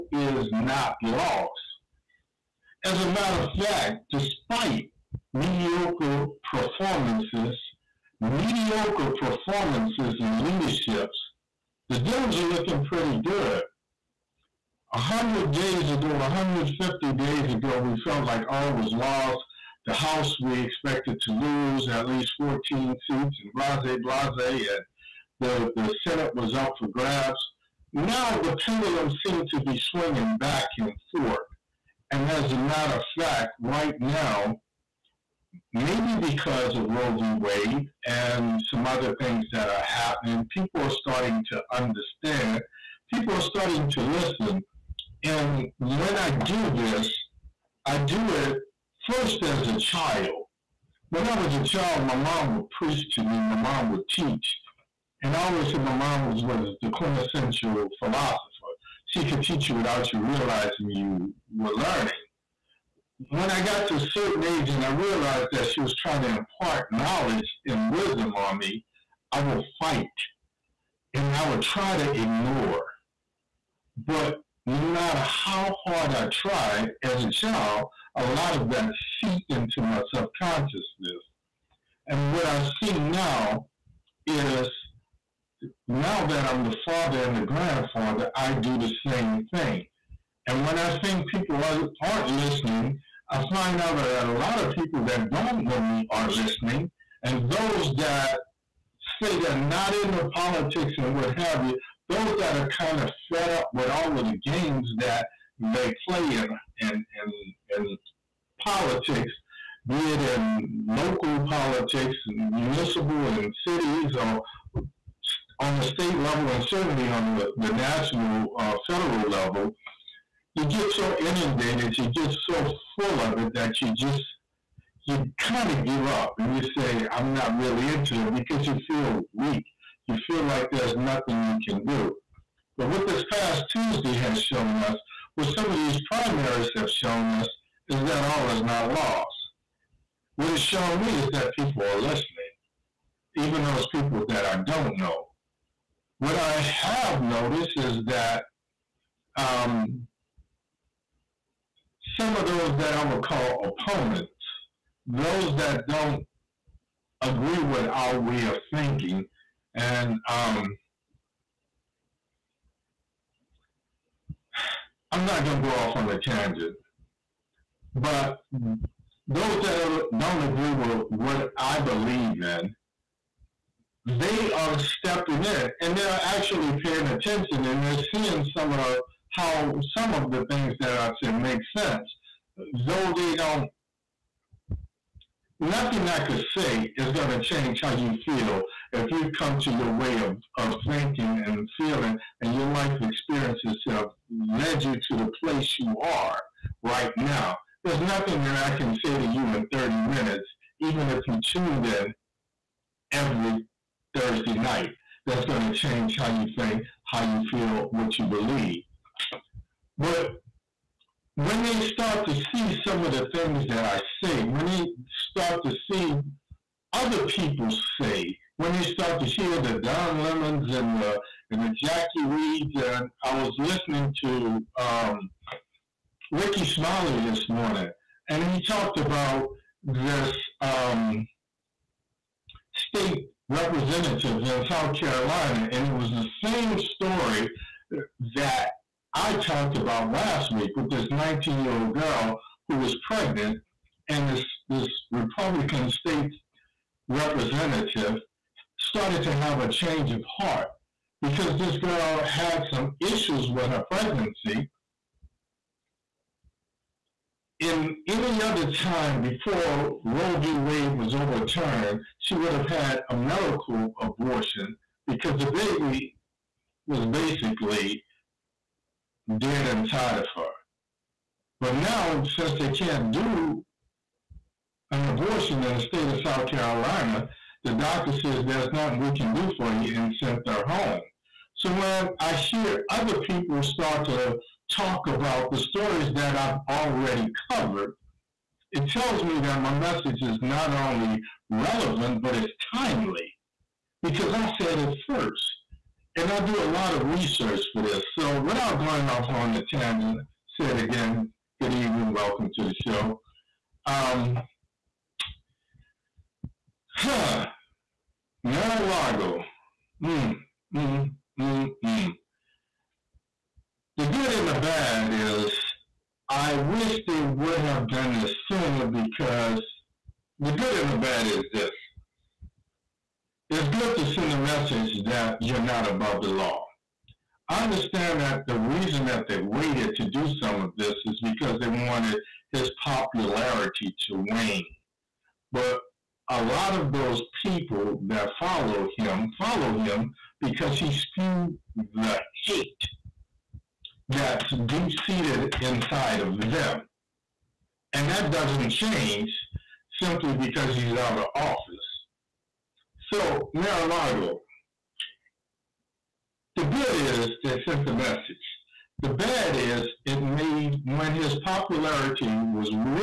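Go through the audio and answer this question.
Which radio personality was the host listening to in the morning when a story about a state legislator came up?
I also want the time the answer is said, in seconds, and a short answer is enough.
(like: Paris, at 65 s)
Rickey Smiley, at 226 s.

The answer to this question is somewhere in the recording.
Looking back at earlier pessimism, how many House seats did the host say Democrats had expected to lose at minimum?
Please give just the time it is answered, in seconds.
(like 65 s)
22 s.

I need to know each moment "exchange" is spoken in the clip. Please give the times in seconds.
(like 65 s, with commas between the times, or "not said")
not said.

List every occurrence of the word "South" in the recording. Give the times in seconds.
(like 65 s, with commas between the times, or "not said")
234 s, 276 s.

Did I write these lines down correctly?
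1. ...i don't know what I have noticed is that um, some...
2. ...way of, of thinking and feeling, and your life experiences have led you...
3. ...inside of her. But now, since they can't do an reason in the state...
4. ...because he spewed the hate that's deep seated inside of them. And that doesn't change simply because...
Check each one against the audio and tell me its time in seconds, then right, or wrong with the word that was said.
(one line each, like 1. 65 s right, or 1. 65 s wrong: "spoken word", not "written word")
1. 144 s right
2. 189 s right
3. 269 s wrong: "abortion", not "reason"
4. 340 s right.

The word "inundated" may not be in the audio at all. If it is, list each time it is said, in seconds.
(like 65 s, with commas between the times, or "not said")
121 s.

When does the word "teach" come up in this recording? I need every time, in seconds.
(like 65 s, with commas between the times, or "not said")
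54 s, 59 s.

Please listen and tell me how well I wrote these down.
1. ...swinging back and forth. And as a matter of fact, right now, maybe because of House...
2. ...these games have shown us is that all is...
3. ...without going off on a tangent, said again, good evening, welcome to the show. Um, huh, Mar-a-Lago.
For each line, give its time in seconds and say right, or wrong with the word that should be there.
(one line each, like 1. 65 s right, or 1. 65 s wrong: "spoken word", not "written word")
1. 29 s wrong: "Roe", not "House"
2. 135 s wrong: "primaries", not "games"
3. 298 s right.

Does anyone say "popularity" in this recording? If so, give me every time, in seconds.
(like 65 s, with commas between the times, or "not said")
332 s, 361 s.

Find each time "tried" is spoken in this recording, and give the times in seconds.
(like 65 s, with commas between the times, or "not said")
76 s.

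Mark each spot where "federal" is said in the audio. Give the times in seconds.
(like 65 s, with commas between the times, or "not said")
118 s.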